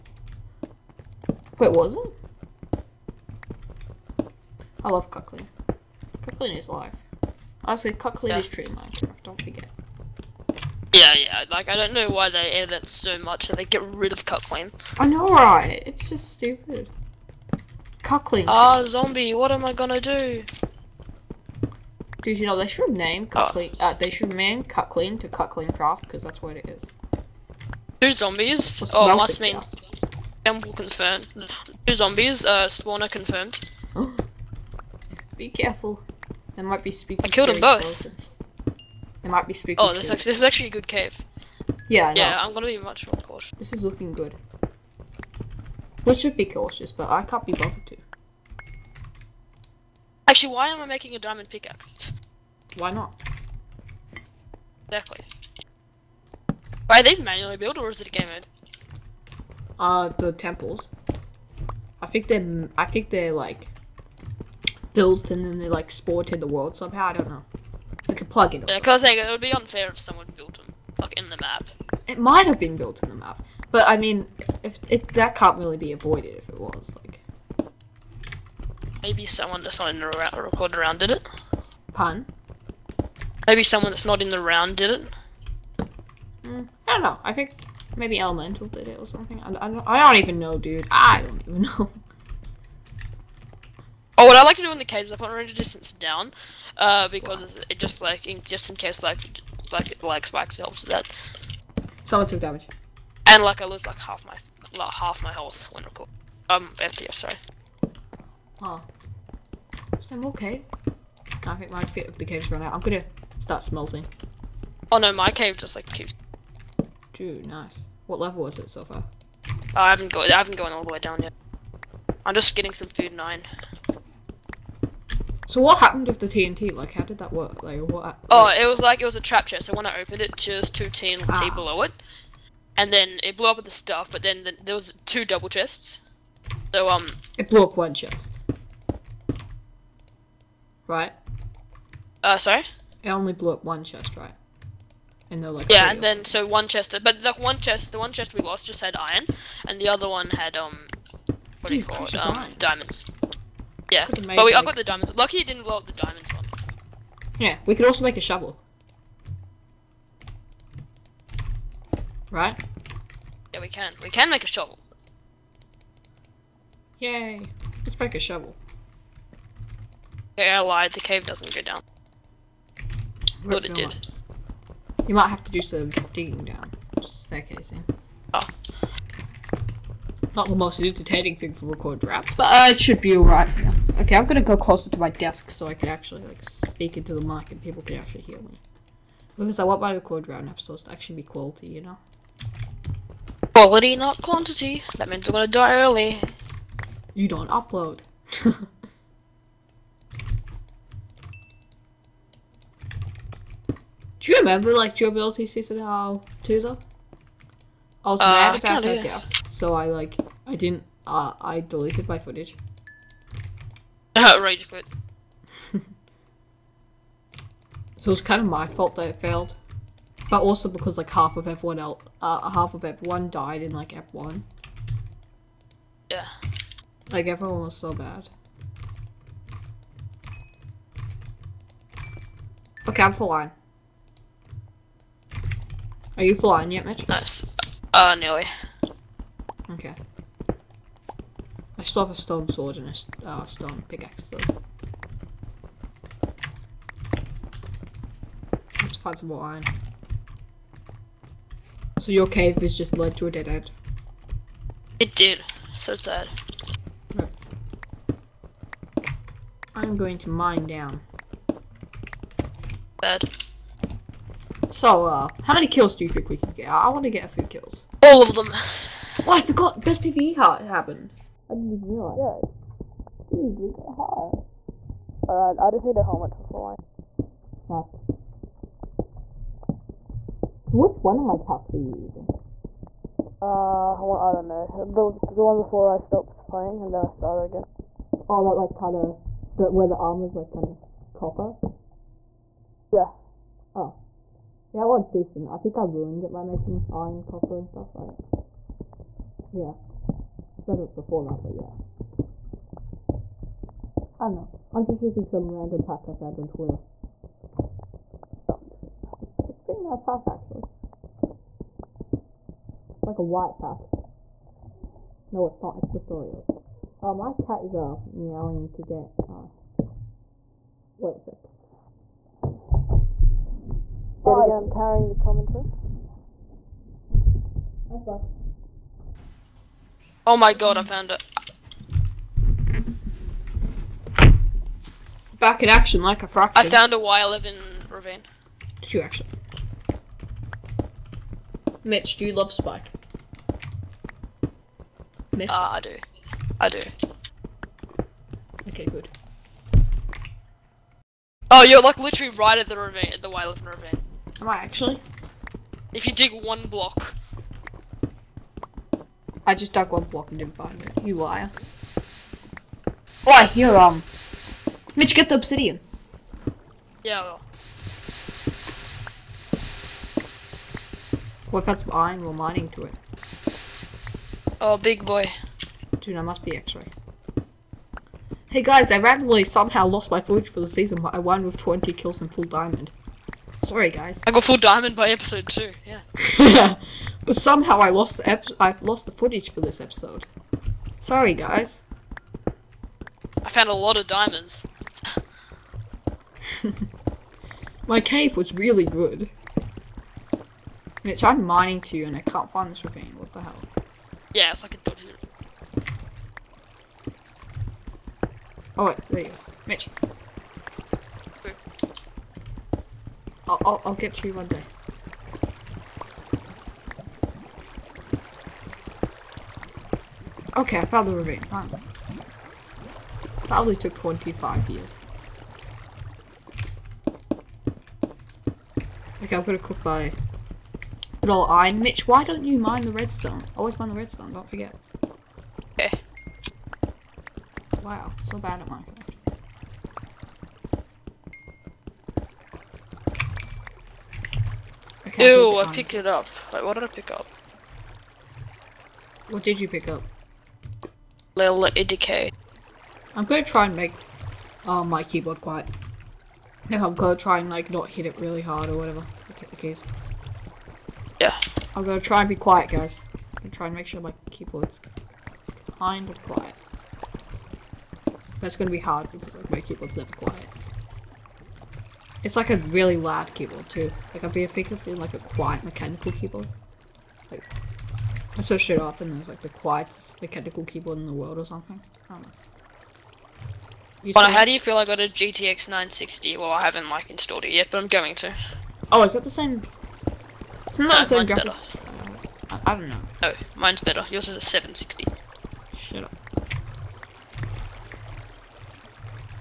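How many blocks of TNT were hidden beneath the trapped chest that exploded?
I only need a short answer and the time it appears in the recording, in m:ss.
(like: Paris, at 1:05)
2, at 2:10.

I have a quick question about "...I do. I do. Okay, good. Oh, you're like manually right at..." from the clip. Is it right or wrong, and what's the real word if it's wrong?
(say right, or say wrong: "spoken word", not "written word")
wrong: "literally", not "manually".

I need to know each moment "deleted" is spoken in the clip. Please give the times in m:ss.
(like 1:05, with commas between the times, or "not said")
3:31.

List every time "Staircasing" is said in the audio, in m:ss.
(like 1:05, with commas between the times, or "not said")
2:57.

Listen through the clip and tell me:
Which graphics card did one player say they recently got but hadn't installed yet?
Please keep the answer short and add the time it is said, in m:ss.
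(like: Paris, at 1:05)
GTX 960, at 8:05.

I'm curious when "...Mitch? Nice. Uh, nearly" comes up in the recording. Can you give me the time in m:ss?
3:56.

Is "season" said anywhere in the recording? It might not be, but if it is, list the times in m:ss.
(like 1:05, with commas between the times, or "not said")
3:25, 6:20.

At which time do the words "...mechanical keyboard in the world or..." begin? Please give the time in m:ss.
8:00.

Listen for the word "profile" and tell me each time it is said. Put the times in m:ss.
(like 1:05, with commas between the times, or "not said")
not said.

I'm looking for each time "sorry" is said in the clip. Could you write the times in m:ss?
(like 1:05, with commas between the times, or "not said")
1:47, 2:22, 6:23, 6:30.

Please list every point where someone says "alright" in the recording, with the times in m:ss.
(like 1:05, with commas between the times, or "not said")
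3:03, 4:35.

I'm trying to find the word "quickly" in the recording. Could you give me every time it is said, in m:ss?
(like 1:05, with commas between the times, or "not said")
not said.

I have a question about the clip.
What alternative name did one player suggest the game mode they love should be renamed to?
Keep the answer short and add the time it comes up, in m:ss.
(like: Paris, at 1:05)
CutClean Craft, at 0:25.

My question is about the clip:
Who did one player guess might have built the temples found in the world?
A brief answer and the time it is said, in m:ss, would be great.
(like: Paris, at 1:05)
Elemental, at 1:28.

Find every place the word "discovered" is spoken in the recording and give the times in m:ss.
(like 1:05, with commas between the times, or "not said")
not said.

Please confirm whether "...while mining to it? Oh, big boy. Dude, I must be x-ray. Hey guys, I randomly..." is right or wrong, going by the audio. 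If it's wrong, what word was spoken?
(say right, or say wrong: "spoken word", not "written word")
right.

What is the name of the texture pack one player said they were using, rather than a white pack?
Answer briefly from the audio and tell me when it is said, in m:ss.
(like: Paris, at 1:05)
Storios, at 5:15.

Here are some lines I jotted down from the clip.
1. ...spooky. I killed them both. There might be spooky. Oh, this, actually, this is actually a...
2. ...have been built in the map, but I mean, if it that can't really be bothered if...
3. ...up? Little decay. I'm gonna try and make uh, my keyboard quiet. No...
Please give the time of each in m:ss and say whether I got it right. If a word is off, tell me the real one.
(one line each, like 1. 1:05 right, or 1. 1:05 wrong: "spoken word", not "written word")
1. 0:36 right
2. 1:12 wrong: "avoided", not "bothered"
3. 7:29 right.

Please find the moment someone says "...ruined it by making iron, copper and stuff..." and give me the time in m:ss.
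4:55.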